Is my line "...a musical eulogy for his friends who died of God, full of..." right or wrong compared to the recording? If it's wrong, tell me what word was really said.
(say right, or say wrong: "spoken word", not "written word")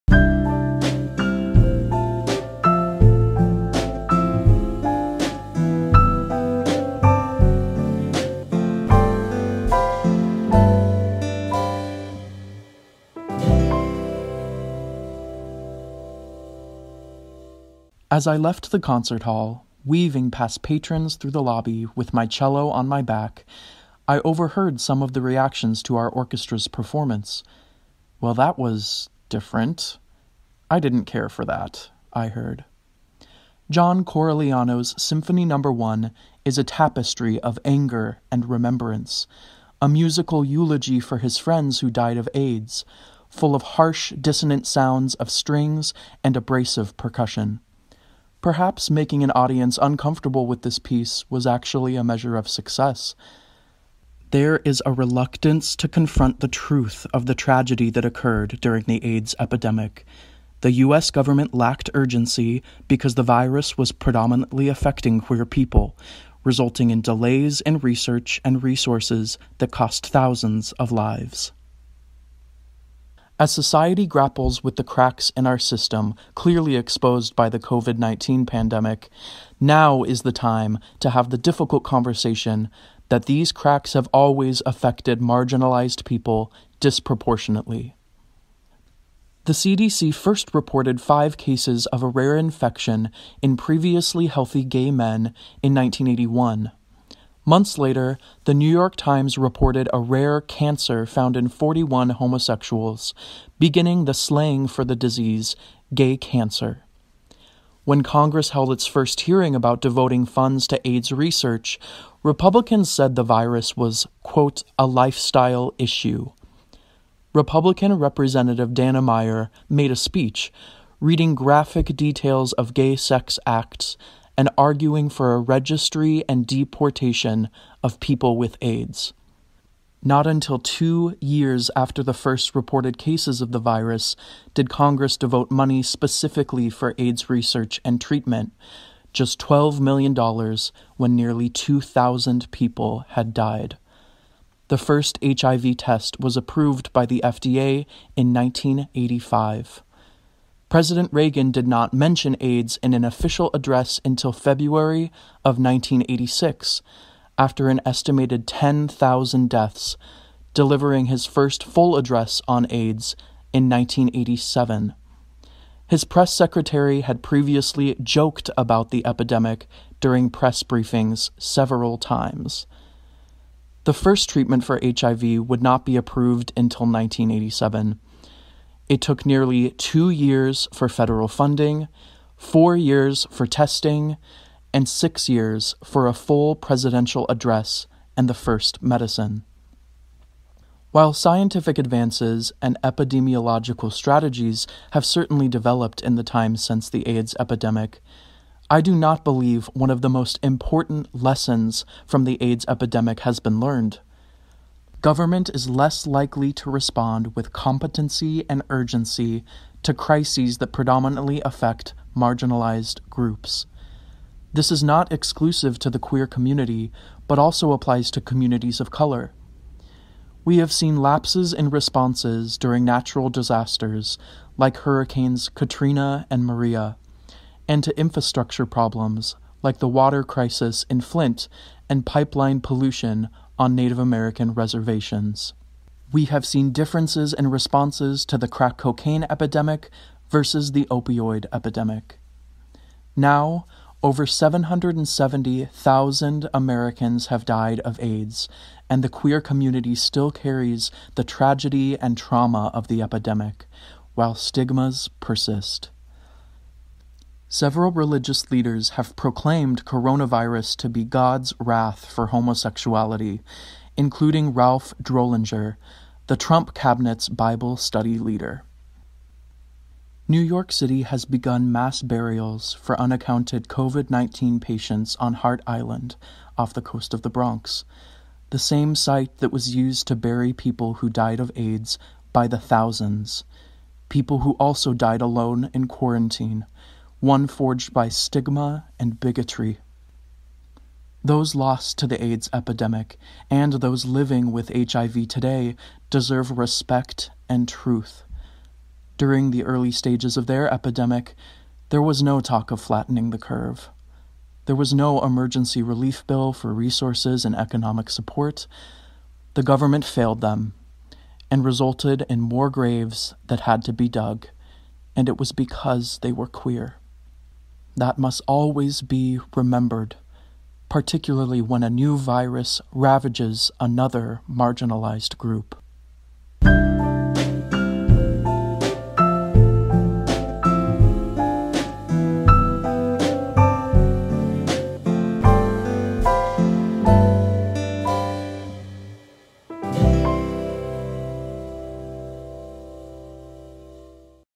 wrong: "AIDS", not "God".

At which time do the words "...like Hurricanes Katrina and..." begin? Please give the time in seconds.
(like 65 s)
224 s.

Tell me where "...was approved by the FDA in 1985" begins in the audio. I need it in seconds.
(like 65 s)
146 s.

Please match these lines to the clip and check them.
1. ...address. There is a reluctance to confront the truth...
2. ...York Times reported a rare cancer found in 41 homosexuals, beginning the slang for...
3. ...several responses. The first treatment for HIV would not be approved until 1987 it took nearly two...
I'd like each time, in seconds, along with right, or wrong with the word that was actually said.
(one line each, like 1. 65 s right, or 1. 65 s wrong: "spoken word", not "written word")
1. 52 s wrong: "success", not "address"
2. 98 s right
3. 171 s wrong: "times", not "responses".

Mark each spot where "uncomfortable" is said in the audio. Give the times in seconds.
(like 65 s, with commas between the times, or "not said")
49 s.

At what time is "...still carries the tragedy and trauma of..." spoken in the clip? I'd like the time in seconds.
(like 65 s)
249 s.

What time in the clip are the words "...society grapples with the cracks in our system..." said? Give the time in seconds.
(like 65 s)
73 s.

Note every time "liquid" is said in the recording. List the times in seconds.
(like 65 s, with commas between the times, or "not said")
not said.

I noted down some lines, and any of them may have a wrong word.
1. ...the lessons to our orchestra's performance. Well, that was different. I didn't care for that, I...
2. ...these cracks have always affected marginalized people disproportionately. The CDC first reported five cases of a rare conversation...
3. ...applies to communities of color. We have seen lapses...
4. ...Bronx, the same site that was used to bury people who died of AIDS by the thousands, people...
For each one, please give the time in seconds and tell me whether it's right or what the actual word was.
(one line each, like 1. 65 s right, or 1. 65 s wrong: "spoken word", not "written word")
1. 25 s wrong: "reactions", not "lessons"
2. 83 s wrong: "infection", not "conversation"
3. 217 s right
4. 277 s right.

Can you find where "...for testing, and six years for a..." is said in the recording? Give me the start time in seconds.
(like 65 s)
183 s.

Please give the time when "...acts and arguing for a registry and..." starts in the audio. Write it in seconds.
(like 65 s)
123 s.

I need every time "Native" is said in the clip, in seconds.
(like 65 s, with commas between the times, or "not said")
233 s.